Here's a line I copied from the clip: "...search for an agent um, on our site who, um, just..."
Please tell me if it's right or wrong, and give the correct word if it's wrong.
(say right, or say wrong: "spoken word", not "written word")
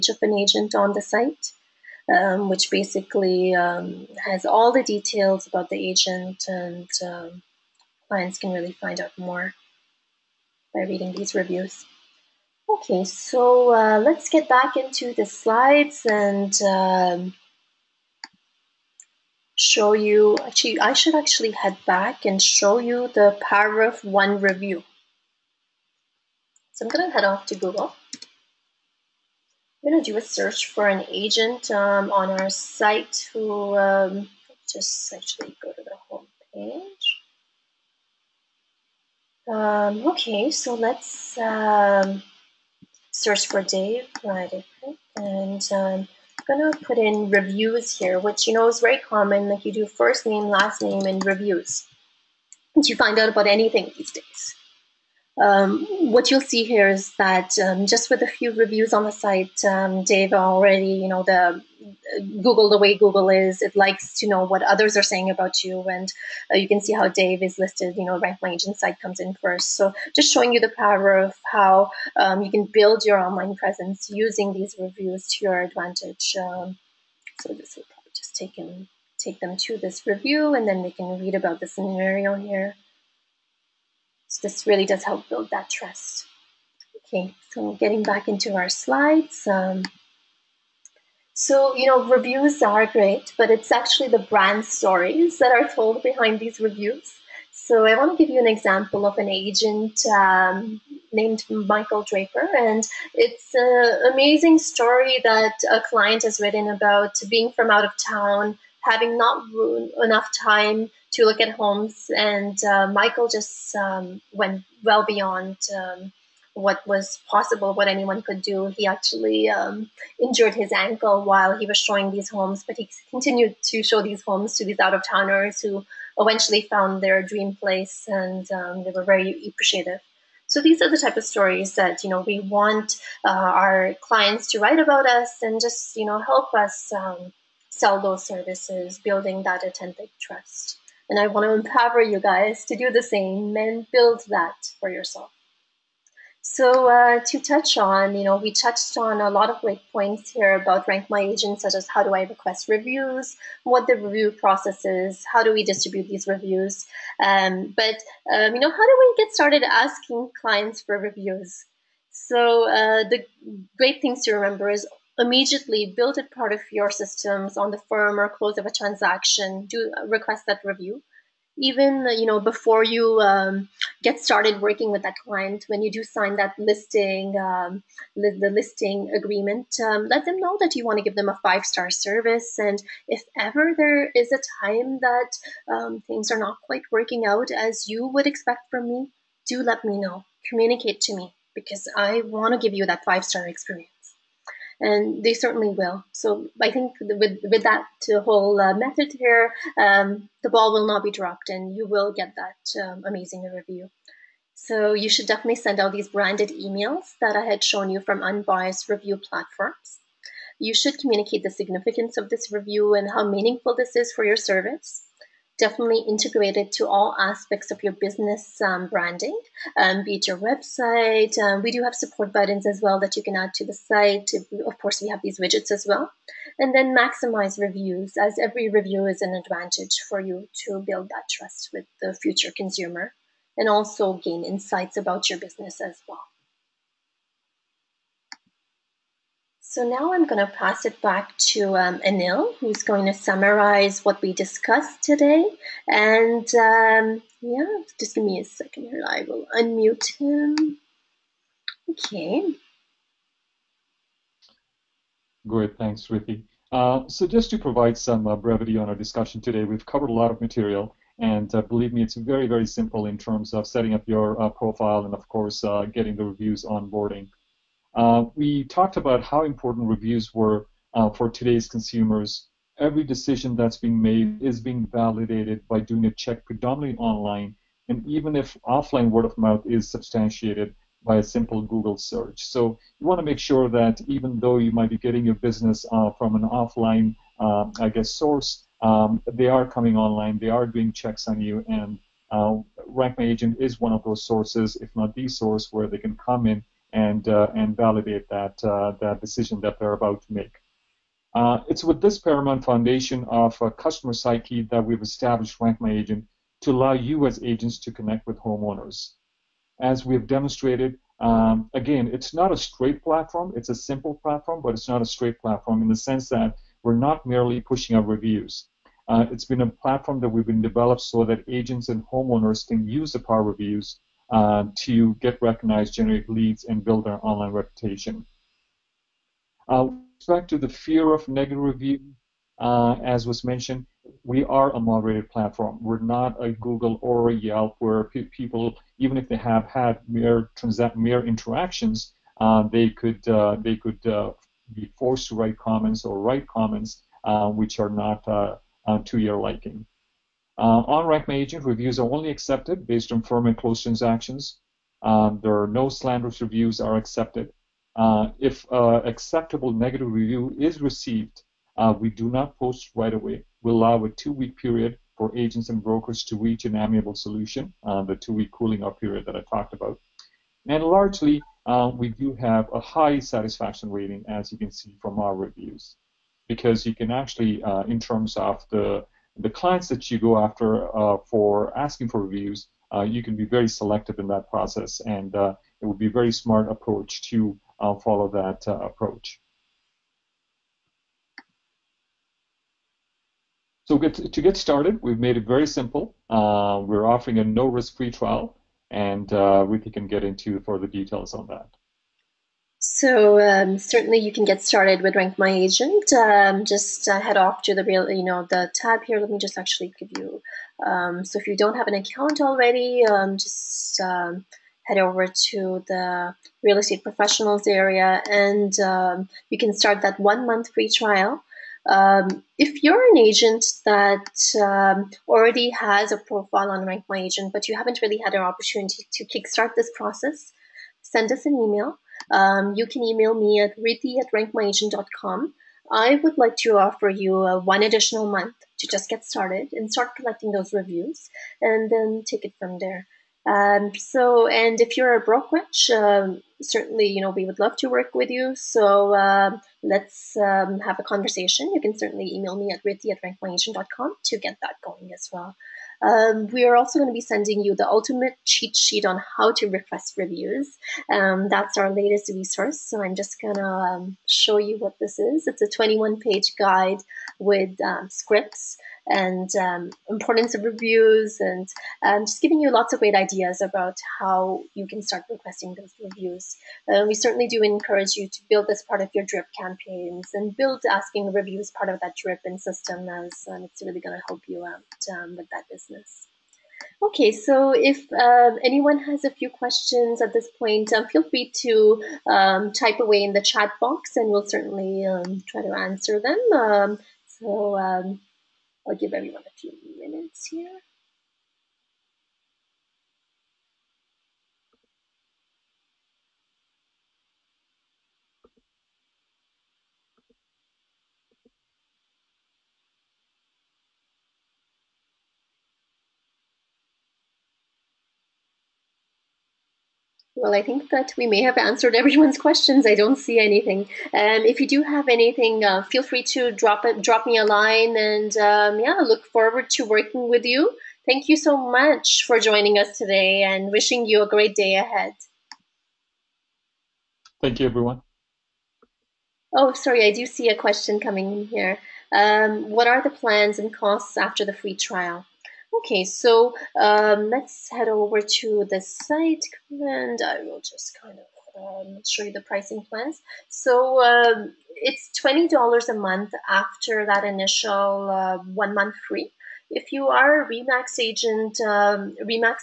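right.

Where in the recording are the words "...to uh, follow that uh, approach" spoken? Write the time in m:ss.
6:27.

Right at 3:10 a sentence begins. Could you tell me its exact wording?
Communicate to me because I want to give you that five star experience and they certainly will.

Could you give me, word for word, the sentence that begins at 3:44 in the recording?
Of course, we have these widgets as well.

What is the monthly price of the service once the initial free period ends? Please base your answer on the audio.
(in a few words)
$20.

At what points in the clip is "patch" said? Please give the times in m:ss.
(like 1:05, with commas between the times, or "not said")
not said.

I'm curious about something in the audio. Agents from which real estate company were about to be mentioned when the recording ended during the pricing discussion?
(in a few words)
Remax.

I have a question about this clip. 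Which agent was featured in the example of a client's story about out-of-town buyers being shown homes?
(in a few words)
Michael Draper.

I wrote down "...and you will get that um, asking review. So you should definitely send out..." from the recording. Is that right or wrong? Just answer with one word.
wrong.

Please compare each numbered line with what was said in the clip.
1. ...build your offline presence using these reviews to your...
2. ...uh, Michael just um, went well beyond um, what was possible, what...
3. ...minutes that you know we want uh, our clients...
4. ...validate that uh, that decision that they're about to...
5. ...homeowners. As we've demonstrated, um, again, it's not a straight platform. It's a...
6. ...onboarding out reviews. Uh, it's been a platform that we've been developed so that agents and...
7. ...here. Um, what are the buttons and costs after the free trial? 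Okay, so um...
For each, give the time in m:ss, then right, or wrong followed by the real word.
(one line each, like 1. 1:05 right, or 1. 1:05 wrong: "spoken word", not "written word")
1. 1:12 wrong: "online", not "offline"
2. 1:52 right
3. 2:11 wrong: "stories", not "minutes"
4. 4:57 right
5. 5:08 right
6. 5:17 wrong: "pushing", not "onboarding"
7. 9:01 wrong: "plans", not "buttons".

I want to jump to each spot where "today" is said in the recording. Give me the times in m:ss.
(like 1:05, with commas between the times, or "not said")
4:05, 4:19, 4:31, 8:52.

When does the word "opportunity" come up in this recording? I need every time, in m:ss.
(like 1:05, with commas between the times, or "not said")
7:08.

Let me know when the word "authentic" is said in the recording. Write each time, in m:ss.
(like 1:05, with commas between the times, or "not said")
2:19.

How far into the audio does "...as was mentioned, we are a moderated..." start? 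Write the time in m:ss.
5:33.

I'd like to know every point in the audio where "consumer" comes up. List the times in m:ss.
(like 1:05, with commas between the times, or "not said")
3:52, 4:31.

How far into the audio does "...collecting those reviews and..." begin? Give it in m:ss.
7:20.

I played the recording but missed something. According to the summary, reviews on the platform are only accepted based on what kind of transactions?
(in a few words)
Firm and close transactions.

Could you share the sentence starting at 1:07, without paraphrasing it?
You know, rank Insight site comes in first.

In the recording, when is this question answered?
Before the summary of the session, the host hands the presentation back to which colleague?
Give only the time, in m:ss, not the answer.
4:02.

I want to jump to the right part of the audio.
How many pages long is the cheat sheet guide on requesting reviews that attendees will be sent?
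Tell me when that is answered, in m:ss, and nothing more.
7:45.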